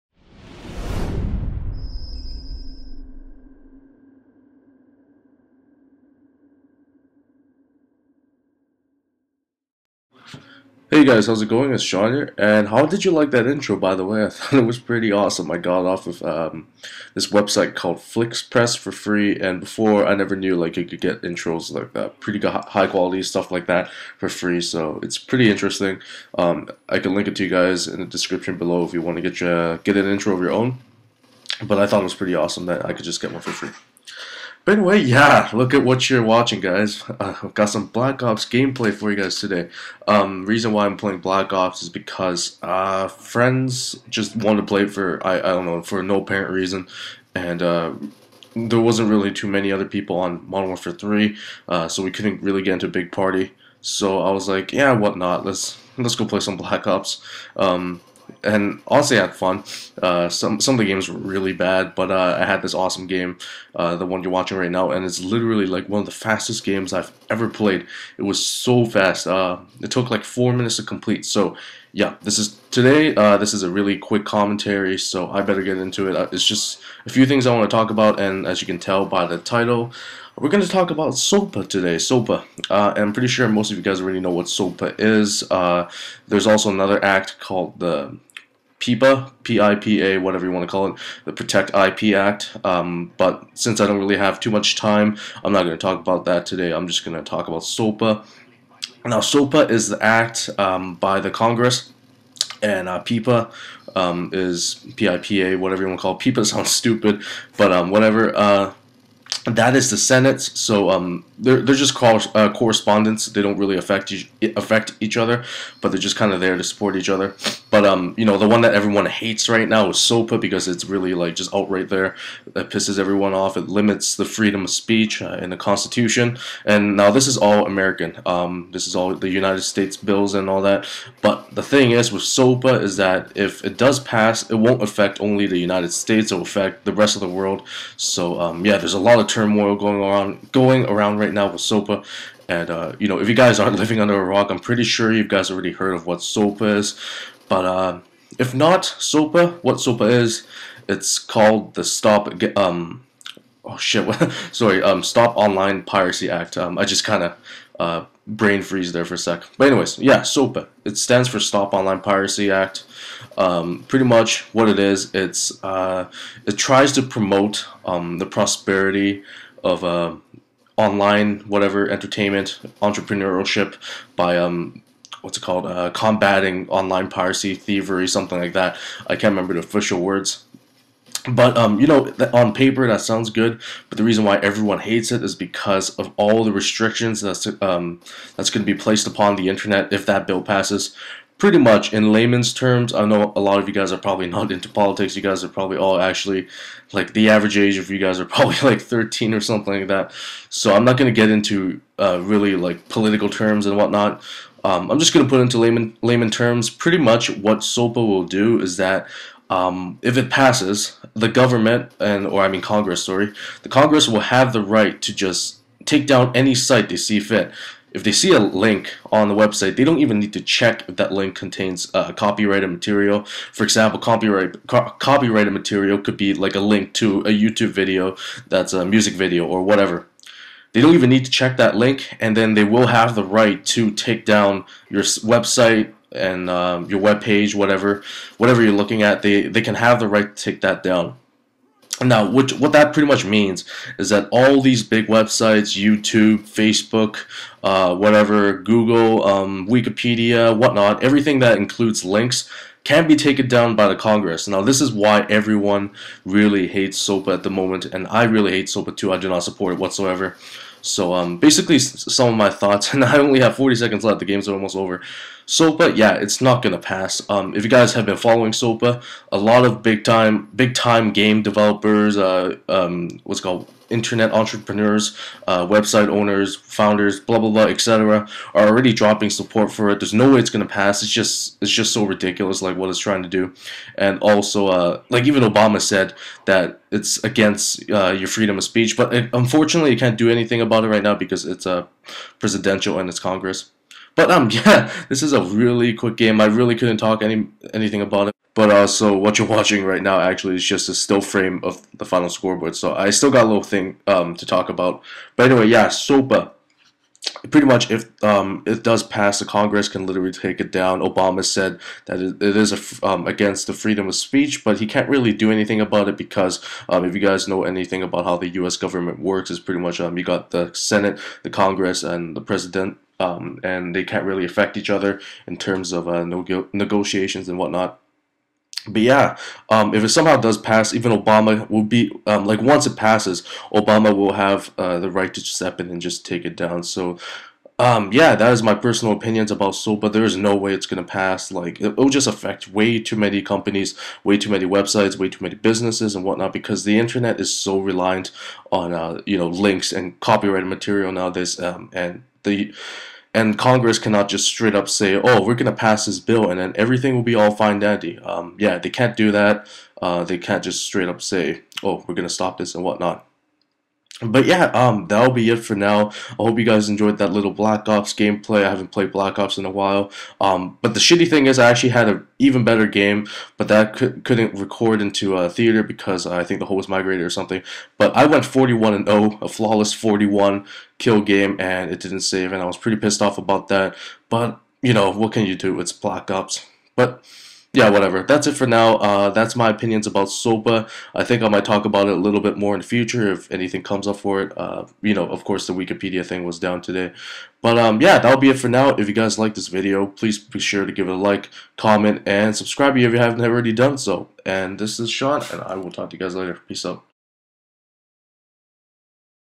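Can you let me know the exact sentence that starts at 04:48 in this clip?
But it, unfortunately, you can't do anything about it right now because it's a uh, presidential and it's Congress.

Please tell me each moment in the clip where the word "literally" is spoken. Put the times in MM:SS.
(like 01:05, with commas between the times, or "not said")
01:05, 05:10.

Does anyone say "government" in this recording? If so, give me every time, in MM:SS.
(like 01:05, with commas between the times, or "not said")
03:31, 05:18.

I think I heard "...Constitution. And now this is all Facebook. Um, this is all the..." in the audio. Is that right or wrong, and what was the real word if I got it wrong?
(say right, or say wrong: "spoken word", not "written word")
wrong: "American", not "Facebook".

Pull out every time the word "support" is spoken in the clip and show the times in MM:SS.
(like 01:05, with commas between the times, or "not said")
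01:56, 04:19, 04:39.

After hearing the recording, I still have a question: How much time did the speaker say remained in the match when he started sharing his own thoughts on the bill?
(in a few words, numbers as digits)
40 seconds.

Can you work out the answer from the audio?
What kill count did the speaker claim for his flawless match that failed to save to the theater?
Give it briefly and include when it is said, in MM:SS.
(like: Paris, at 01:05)
41, at 06:18.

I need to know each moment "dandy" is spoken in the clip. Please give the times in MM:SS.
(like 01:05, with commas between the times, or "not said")
05:57.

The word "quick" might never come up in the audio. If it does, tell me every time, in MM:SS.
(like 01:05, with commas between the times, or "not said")
01:13, 04:55.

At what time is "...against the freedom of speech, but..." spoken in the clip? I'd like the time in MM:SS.
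05:13.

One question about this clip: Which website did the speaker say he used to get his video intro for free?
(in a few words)
FlixPress.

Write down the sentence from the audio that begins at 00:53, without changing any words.
So I was like, yeah, whatnot, let's let's go play some Black Ops.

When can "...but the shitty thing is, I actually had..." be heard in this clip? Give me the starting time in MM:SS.
06:10.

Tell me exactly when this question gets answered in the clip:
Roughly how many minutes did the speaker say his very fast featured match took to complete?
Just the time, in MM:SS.
01:10.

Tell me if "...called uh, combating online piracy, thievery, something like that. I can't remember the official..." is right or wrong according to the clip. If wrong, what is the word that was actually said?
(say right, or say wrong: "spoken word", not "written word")
right.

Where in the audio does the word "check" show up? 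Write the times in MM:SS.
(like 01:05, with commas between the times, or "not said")
03:40, 03:51.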